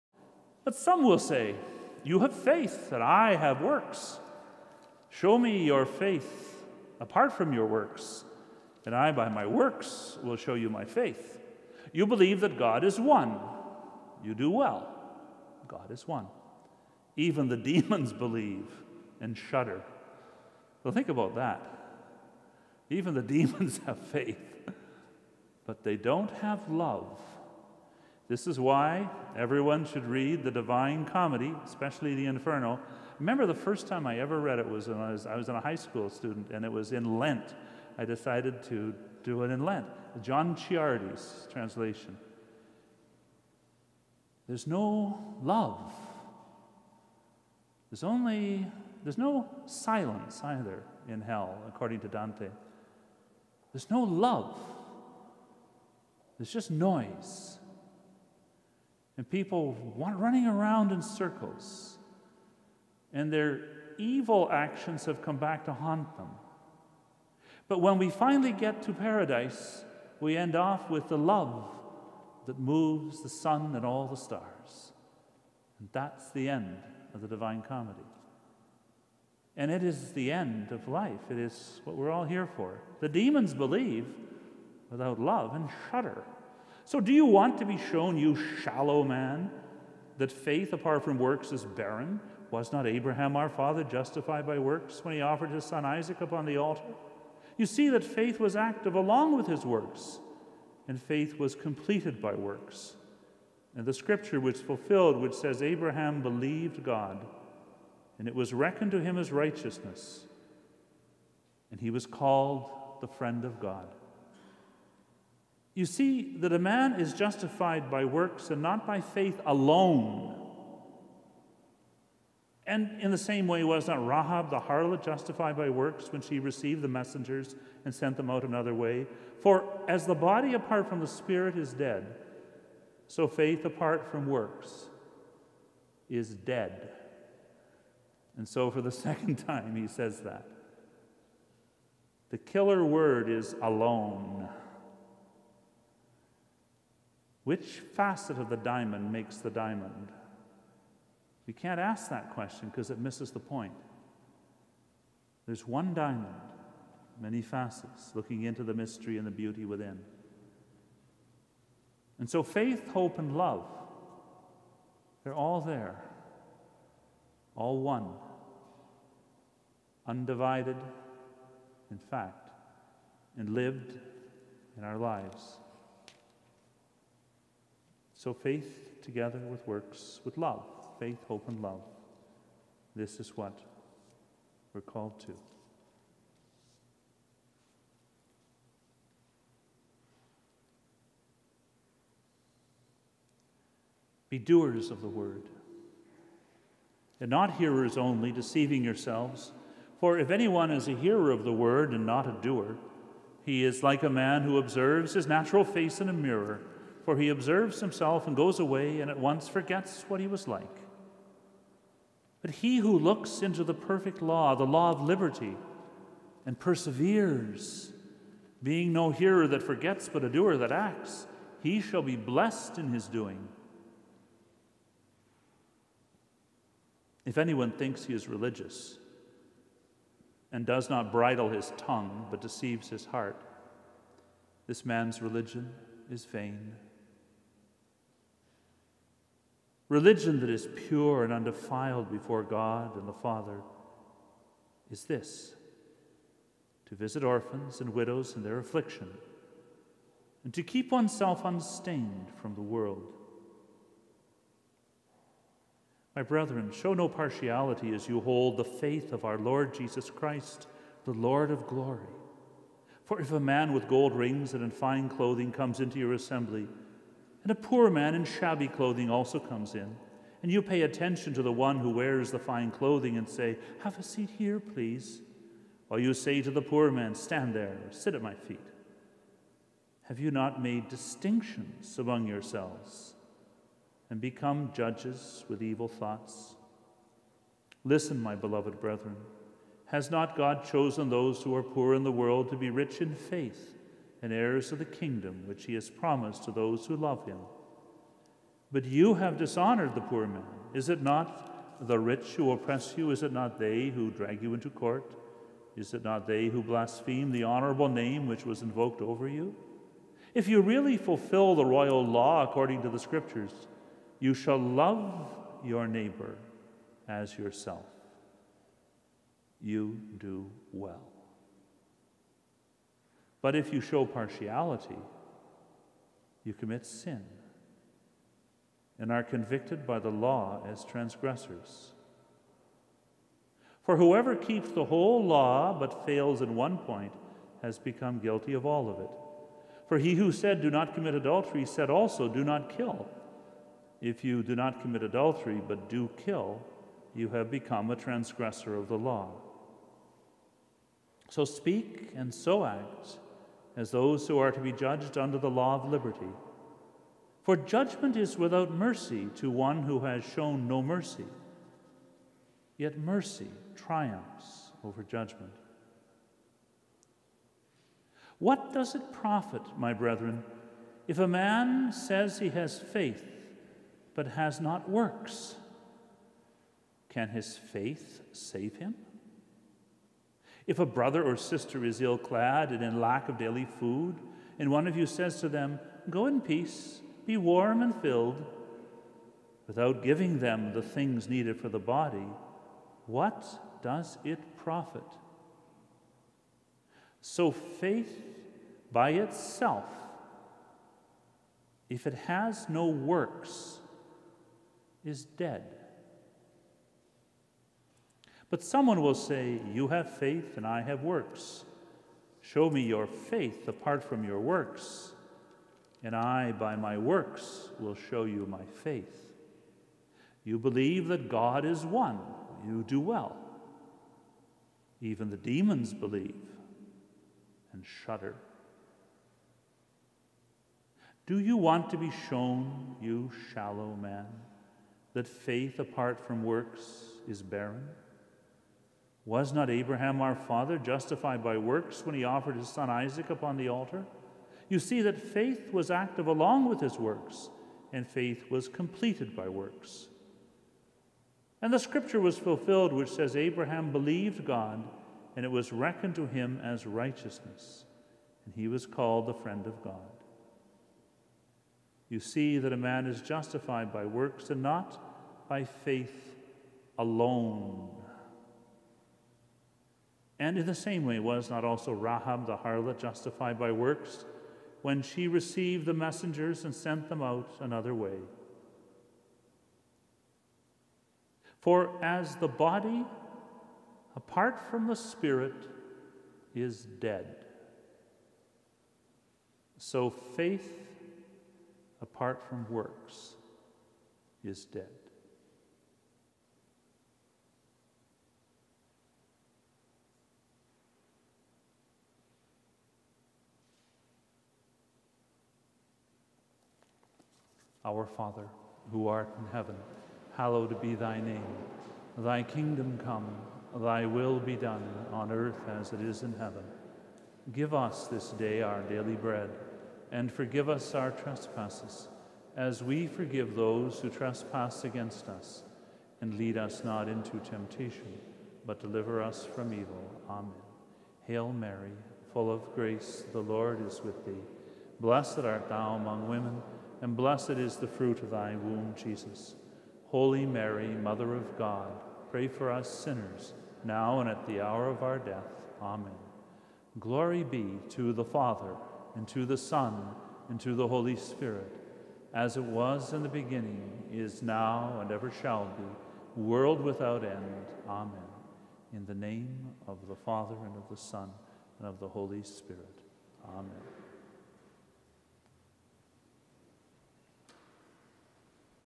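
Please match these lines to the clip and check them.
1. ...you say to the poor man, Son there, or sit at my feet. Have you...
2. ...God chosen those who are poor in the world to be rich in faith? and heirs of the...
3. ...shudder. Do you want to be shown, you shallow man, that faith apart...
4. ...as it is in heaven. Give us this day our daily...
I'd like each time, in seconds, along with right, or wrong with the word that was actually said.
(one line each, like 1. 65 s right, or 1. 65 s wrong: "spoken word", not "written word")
1. 275 s wrong: "Stand", not "Son"
2. 290 s right
3. 428 s right
4. 515 s right.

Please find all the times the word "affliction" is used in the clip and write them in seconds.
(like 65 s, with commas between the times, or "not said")
248 s.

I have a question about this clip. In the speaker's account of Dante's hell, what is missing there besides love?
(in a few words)
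silence.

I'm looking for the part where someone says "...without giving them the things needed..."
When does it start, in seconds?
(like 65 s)
389 s.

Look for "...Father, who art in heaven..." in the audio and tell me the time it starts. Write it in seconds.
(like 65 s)
508 s.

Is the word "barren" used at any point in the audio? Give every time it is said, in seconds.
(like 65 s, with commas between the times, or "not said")
91 s, 437 s.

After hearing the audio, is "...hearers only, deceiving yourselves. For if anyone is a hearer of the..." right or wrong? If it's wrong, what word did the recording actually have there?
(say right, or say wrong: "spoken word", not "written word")
right.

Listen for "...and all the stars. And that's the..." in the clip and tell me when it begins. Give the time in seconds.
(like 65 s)
73 s.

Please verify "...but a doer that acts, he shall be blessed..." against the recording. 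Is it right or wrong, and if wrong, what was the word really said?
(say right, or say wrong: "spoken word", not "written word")
right.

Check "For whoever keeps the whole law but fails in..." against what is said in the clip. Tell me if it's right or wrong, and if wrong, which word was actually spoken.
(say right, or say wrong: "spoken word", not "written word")
right.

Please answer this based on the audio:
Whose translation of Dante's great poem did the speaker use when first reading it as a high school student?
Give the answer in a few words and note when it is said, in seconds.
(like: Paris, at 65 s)
John Ciardi, at 40 s.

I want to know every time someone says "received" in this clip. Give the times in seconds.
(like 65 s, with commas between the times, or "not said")
126 s, 475 s.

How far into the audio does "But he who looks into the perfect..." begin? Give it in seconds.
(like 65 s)
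212 s.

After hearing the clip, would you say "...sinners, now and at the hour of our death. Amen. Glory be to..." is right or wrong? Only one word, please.
right.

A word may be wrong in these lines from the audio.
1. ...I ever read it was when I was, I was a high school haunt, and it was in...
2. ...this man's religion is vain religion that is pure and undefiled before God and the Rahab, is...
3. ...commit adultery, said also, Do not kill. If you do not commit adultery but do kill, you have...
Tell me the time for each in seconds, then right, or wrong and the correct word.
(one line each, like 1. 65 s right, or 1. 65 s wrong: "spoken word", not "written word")
1. 34 s wrong: "student", not "haunt"
2. 234 s wrong: "Father", not "Rahab"
3. 340 s right.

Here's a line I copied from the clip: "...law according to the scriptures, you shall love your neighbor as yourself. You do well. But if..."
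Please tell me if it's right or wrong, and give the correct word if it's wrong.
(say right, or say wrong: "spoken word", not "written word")
right.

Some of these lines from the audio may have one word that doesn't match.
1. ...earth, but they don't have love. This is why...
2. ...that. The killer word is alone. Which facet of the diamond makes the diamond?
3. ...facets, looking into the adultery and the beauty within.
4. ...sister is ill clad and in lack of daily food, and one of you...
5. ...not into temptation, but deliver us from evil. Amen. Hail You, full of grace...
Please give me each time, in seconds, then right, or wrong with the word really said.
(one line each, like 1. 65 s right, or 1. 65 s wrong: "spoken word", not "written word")
1. 23 s wrong: "faith", not "earth"
2. 140 s right
3. 157 s wrong: "mystery", not "adultery"
4. 381 s right
5. 526 s wrong: "Mary", not "You".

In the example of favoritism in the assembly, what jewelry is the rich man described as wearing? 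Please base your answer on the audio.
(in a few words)
gold rings.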